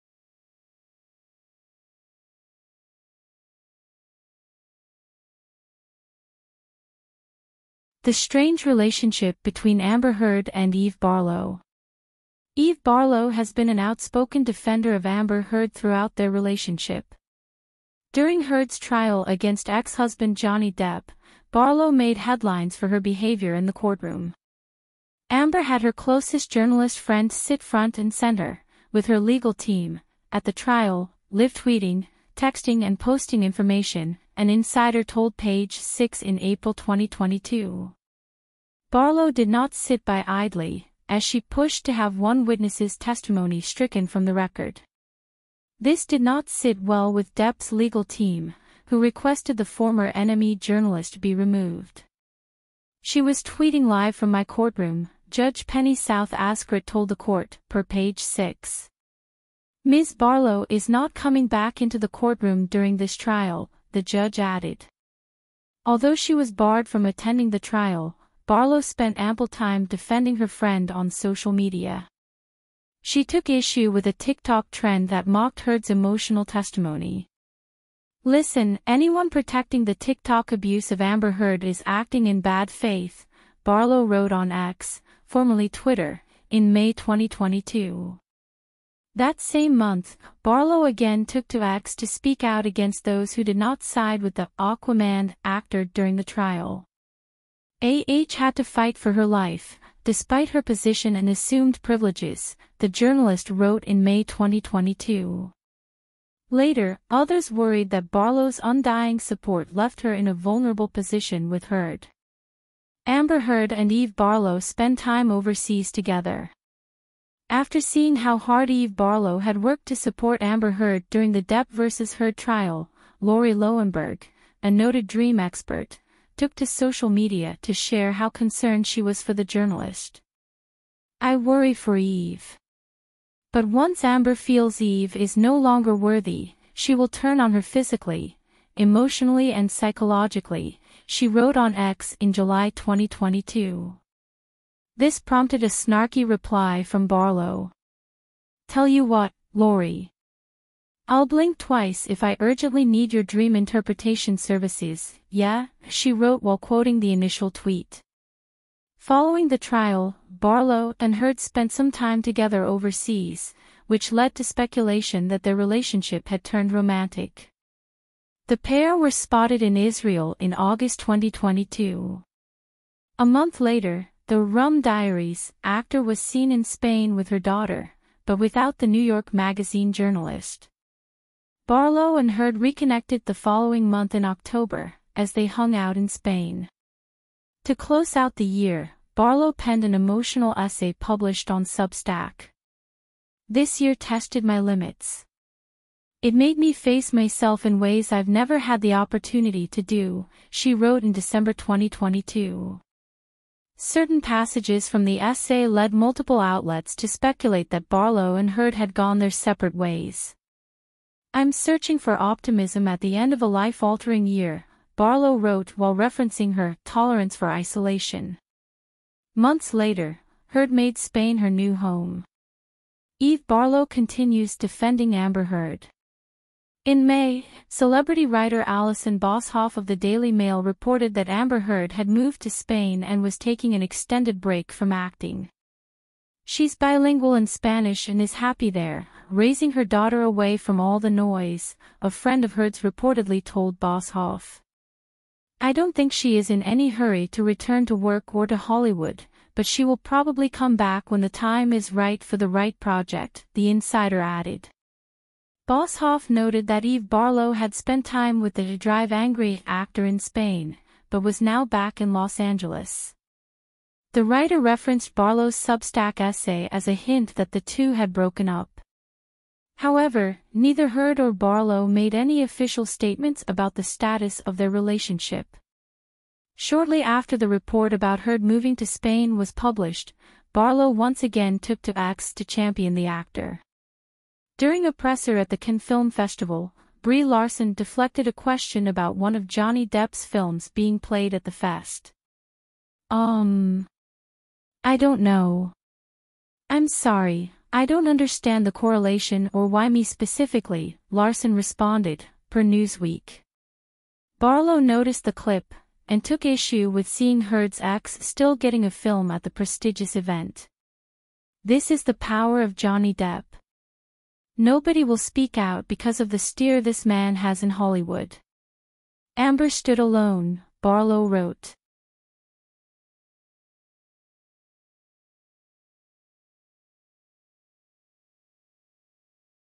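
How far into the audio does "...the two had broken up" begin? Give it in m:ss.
4:27.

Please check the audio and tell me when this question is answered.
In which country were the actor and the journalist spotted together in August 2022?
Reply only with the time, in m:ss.
2:49.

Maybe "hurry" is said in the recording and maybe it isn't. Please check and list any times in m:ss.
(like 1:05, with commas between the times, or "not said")
4:06.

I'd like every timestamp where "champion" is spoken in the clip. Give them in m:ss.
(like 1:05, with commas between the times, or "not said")
4:42.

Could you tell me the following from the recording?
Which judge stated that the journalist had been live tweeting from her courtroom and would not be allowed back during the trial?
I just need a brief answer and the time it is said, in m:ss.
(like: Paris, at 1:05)
Penney S. Azcarate, at 0:55.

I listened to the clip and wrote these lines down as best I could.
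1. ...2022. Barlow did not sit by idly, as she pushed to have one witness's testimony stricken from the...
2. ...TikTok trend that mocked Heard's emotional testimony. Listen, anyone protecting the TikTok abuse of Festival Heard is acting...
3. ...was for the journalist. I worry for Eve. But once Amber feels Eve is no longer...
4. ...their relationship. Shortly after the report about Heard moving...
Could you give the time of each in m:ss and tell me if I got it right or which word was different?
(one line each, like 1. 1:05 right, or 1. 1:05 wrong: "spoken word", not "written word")
1. 0:36 right
2. 1:14 wrong: "Amber", not "Festival"
3. 2:09 right
4. 4:34 right.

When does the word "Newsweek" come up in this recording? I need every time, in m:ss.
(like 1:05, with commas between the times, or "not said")
5:02.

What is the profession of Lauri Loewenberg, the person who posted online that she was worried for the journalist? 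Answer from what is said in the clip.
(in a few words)
dream expert.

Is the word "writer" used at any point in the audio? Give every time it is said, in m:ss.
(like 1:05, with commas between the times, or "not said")
3:48, 4:24.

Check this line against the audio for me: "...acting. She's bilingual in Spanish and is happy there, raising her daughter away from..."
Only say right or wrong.
right.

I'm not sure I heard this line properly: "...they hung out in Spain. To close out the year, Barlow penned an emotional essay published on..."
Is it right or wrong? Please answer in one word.
right.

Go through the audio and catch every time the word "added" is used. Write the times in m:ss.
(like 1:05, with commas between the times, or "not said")
1:04, 4:14.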